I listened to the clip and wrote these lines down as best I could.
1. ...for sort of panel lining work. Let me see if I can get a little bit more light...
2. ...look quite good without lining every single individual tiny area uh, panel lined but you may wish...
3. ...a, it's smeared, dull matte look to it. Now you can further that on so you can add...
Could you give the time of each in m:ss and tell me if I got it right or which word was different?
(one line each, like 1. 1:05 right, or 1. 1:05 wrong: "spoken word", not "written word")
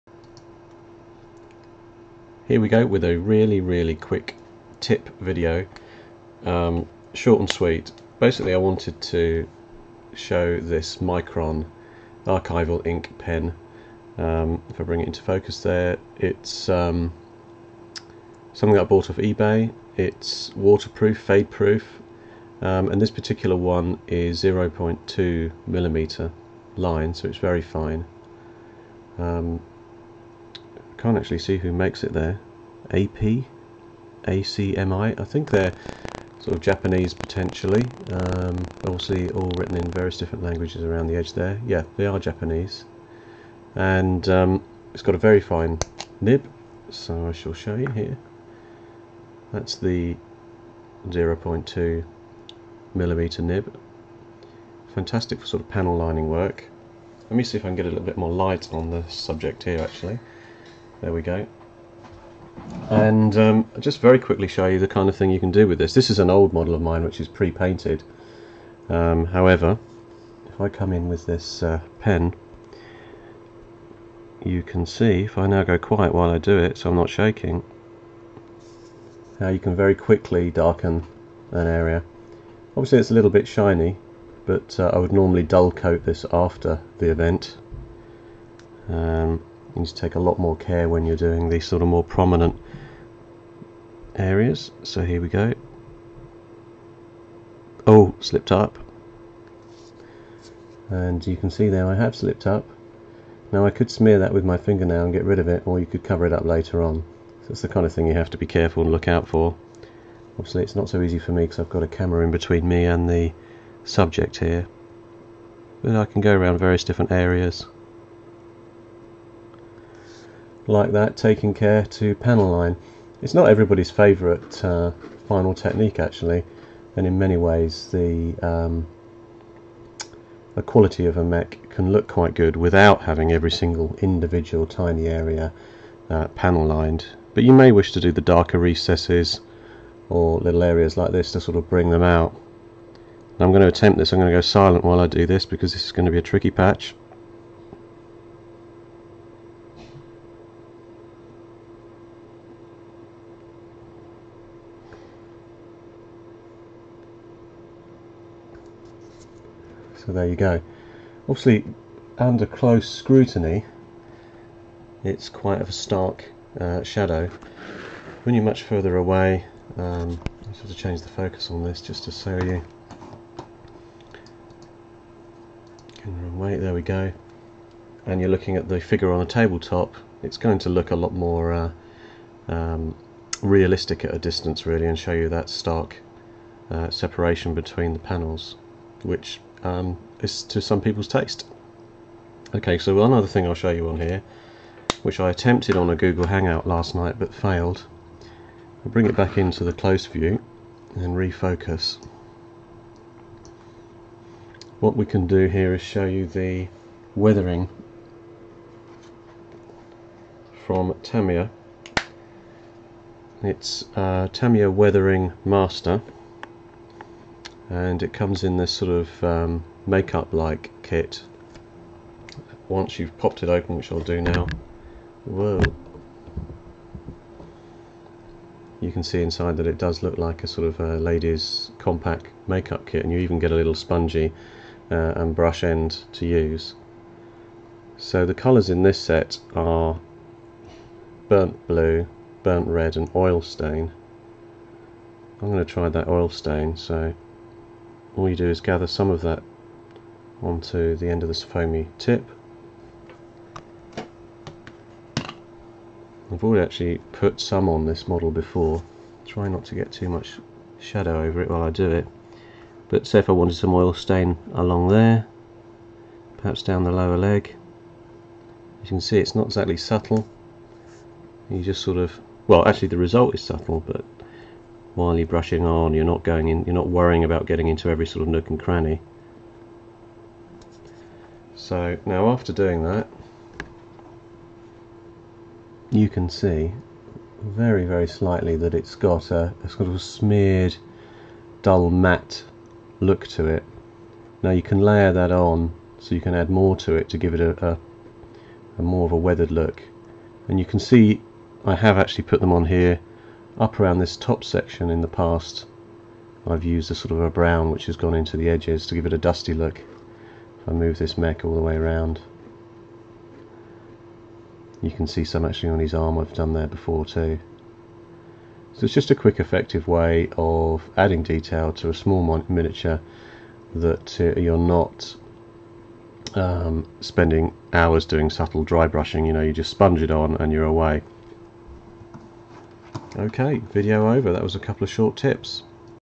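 1. 0:55 right
2. 2:11 wrong: "having", not "lining"
3. 4:49 wrong: "layer", not "further".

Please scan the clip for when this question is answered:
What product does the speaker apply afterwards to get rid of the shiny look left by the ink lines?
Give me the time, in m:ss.
1:25.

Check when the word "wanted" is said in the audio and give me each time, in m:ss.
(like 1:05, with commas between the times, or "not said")
0:08, 4:23.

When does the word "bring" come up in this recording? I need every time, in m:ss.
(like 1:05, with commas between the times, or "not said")
0:14, 2:21, 3:18.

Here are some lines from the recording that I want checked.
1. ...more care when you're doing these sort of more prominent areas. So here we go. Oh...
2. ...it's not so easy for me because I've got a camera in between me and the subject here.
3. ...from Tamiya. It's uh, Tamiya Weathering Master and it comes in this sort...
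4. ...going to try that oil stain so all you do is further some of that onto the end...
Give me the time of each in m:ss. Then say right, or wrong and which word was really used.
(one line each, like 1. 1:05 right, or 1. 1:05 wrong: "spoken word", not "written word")
1. 1:30 right
2. 1:50 right
3. 3:30 right
4. 4:05 wrong: "gather", not "further".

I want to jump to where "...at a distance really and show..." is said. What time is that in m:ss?
3:04.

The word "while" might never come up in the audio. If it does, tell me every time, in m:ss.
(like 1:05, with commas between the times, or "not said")
1:16, 2:24, 4:21, 4:34.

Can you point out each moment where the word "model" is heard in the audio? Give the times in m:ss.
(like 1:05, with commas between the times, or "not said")
1:06, 4:18.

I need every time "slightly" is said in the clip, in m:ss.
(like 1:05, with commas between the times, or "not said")
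4:48.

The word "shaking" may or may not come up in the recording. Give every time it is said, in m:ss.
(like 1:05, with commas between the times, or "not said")
1:17.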